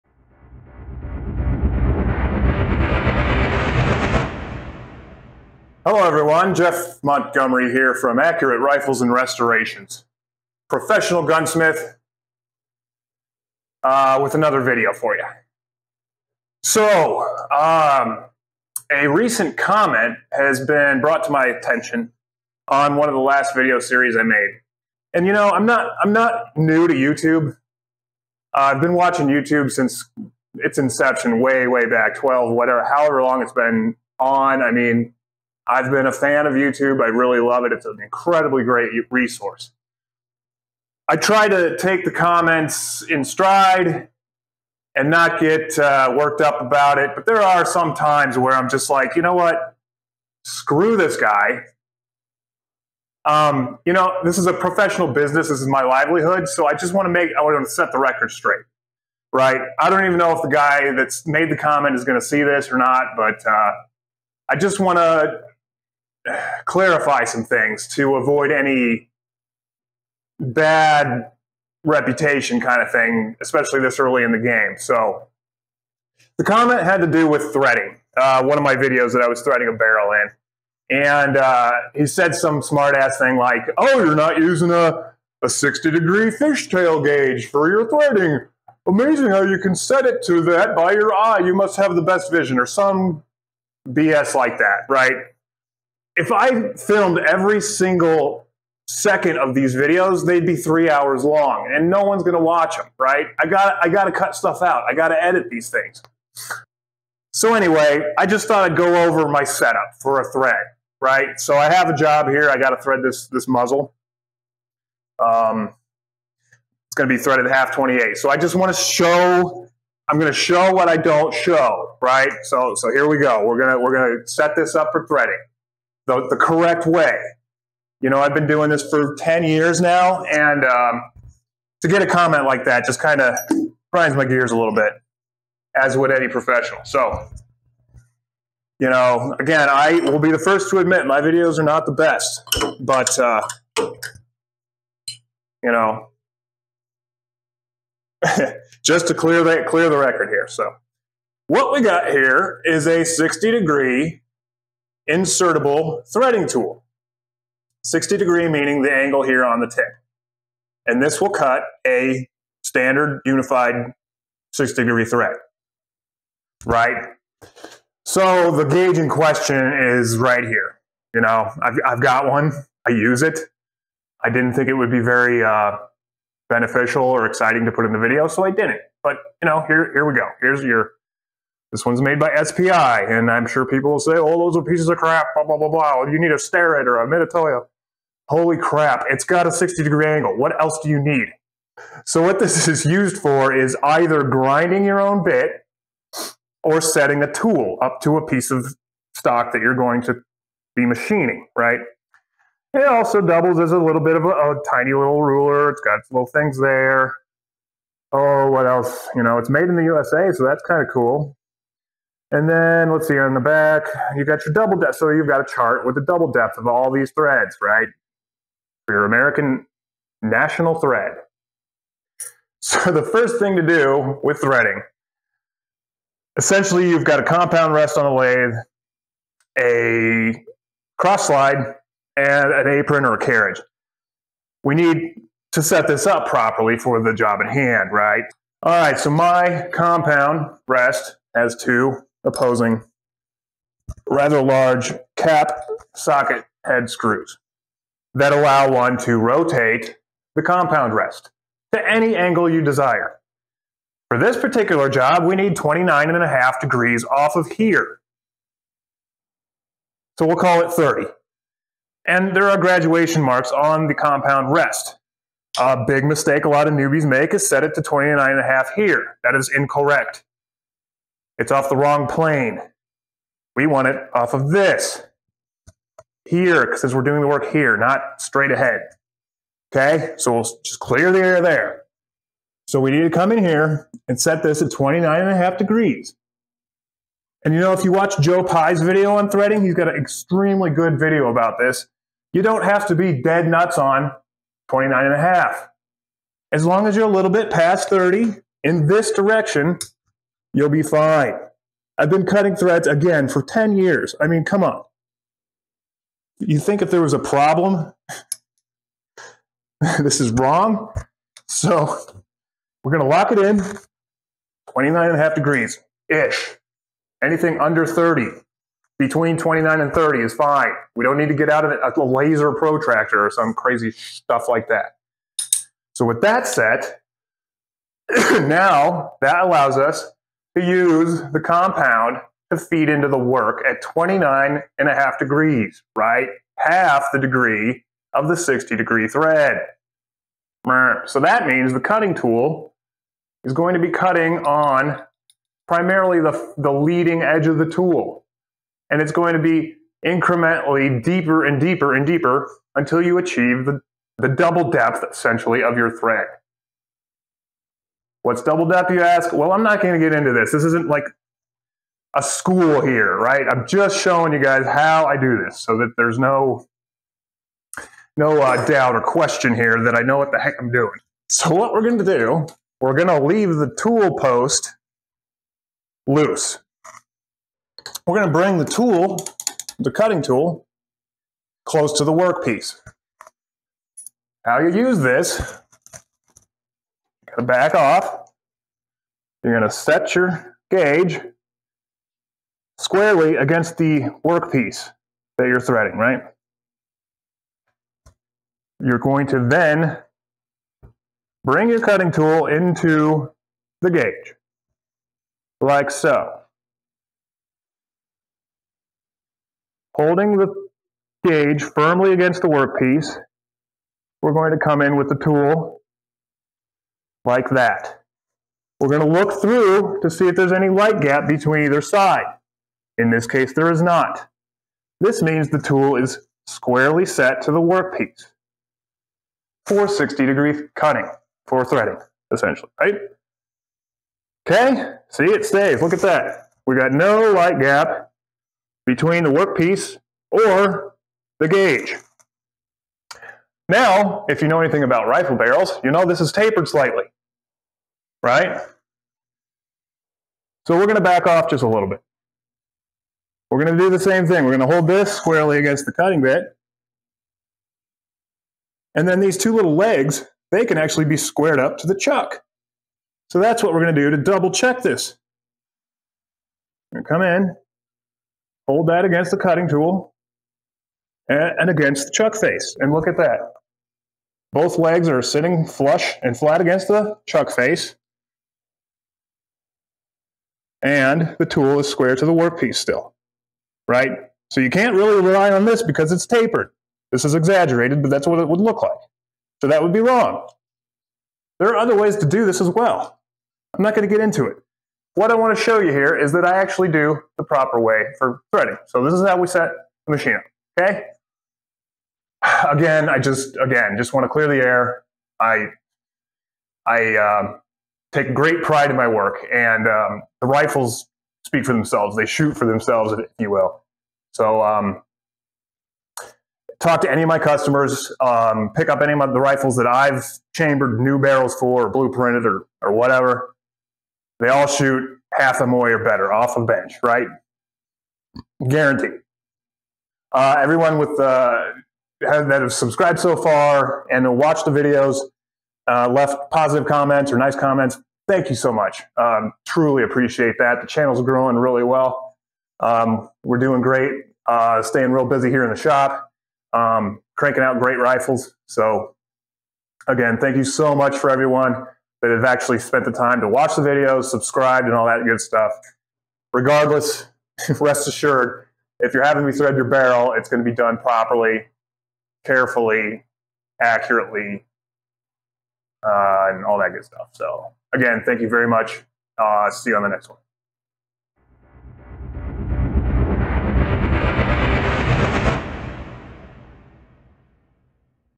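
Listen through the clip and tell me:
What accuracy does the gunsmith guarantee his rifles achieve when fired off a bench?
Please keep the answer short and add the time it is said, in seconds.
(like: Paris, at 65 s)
half a MOA or better, at 525 s.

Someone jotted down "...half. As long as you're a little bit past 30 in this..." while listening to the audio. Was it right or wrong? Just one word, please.
right.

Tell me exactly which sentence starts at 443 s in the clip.
Now, if you know anything about rifle barrels, you know this is tapered slightly, right?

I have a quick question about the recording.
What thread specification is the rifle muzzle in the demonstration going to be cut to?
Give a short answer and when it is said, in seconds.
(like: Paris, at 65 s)
half 28, at 117 s.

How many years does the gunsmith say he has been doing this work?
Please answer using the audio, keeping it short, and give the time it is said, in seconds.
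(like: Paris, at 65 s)
10, at 129 s.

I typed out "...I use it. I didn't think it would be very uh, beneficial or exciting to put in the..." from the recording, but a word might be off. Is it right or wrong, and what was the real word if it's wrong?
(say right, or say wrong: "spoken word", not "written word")
right.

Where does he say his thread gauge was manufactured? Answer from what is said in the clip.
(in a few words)
USA.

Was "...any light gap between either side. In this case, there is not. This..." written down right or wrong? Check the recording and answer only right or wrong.
right.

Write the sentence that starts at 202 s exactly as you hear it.
It also doubles as a little bit of a, a tiny little ruler.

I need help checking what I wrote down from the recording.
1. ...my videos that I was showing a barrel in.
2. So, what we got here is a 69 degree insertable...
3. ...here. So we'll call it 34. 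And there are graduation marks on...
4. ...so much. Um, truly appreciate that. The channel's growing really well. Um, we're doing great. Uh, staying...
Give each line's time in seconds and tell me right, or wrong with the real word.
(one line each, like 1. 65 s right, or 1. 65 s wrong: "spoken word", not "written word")
1. 78 s wrong: "threading", not "showing"
2. 150 s wrong: "60", not "69"
3. 257 s wrong: "30", not "34"
4. 538 s right.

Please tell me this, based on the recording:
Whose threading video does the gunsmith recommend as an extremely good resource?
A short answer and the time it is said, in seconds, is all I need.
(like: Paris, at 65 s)
Joe Pie, at 288 s.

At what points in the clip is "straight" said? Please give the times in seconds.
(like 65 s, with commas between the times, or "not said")
58 s, 278 s.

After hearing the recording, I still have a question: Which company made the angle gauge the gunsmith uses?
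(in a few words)
SPI.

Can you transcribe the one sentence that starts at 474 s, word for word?
Both legs are sitting flush and flat against the chuck face.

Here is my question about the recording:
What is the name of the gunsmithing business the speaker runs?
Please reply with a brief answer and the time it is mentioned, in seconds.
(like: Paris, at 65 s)
Accurate Rifles and Restorations, at 8 s.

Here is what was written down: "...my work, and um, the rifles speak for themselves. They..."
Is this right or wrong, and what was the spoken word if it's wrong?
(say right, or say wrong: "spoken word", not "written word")
right.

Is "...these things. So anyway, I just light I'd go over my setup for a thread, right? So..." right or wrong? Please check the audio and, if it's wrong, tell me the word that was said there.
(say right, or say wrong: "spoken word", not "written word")
wrong: "thought", not "light".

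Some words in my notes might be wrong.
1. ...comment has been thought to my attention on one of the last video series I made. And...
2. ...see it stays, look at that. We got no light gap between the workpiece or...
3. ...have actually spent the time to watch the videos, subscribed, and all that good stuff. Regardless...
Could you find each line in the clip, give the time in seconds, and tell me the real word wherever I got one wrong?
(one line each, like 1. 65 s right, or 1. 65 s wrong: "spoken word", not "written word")
1. 19 s wrong: "brought", not "thought"
2. 435 s right
3. 552 s right.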